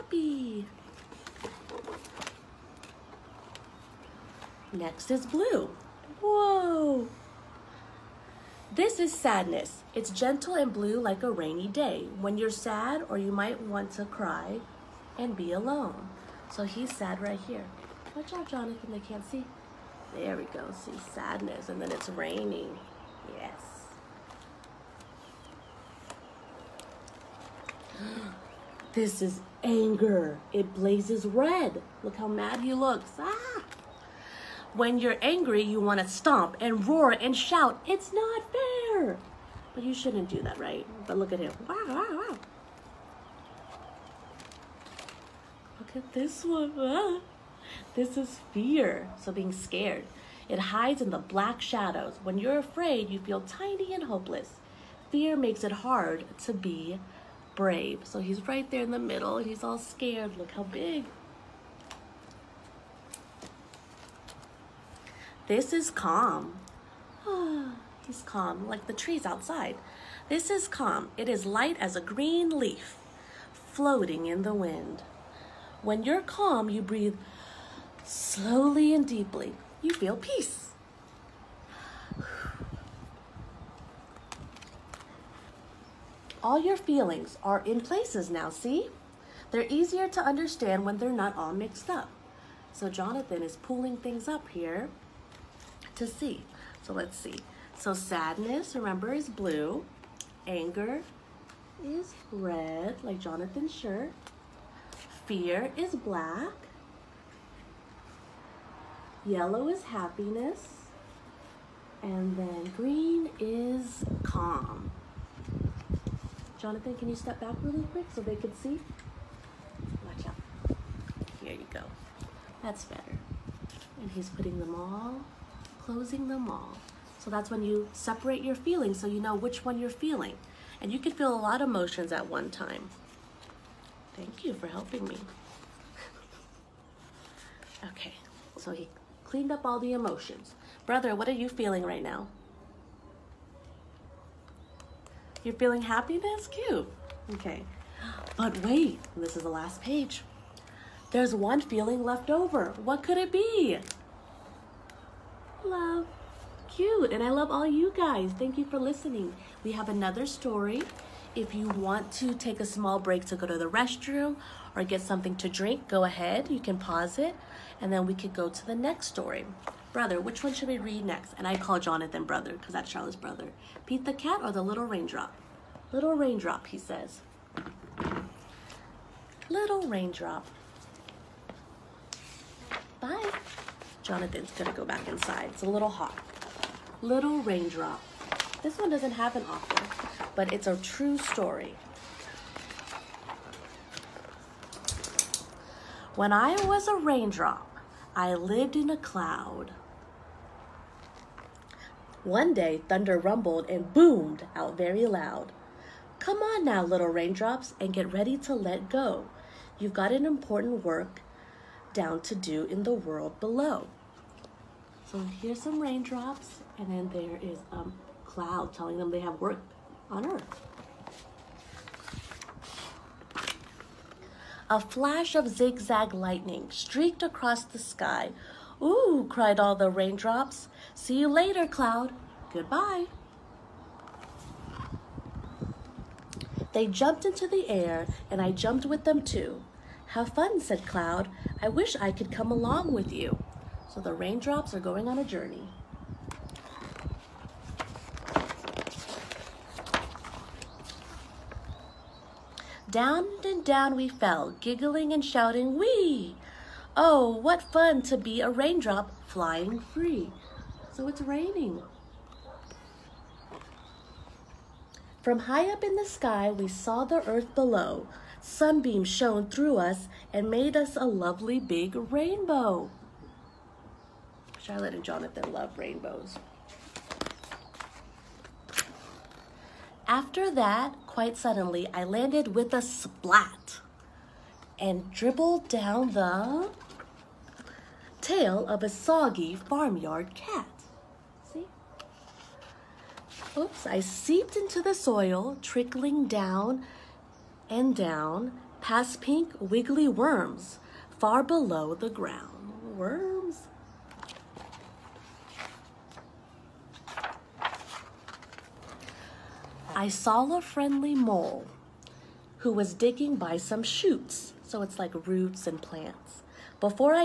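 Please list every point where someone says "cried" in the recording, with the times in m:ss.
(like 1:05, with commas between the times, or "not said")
3:49.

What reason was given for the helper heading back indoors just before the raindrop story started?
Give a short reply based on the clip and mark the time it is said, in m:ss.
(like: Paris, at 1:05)
It's a little hot, at 3:05.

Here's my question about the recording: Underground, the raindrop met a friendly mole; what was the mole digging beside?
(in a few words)
Shoots.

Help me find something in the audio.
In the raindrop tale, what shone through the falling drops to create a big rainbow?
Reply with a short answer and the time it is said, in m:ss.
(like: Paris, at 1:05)
Sunbeams, at 4:28.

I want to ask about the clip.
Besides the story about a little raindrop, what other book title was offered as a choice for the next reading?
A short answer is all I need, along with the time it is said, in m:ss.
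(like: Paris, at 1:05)
Pete the Cat, at 2:53.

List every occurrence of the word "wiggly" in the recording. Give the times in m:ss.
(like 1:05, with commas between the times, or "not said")
4:59.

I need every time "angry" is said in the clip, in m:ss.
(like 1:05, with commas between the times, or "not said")
0:35.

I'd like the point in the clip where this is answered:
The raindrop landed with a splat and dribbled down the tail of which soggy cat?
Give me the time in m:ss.
4:49.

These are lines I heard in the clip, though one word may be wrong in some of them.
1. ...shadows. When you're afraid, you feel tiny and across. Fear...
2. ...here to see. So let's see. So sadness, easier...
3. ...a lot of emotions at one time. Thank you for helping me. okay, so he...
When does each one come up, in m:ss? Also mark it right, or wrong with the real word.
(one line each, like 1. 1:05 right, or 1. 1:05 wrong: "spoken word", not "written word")
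1. 0:51 wrong: "hopeless", not "across"
2. 1:34 wrong: "remember", not "easier"
3. 2:11 right.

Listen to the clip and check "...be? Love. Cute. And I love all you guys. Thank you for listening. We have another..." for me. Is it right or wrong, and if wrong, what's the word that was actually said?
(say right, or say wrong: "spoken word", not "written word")
right.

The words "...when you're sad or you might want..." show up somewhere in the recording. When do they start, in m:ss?
0:12.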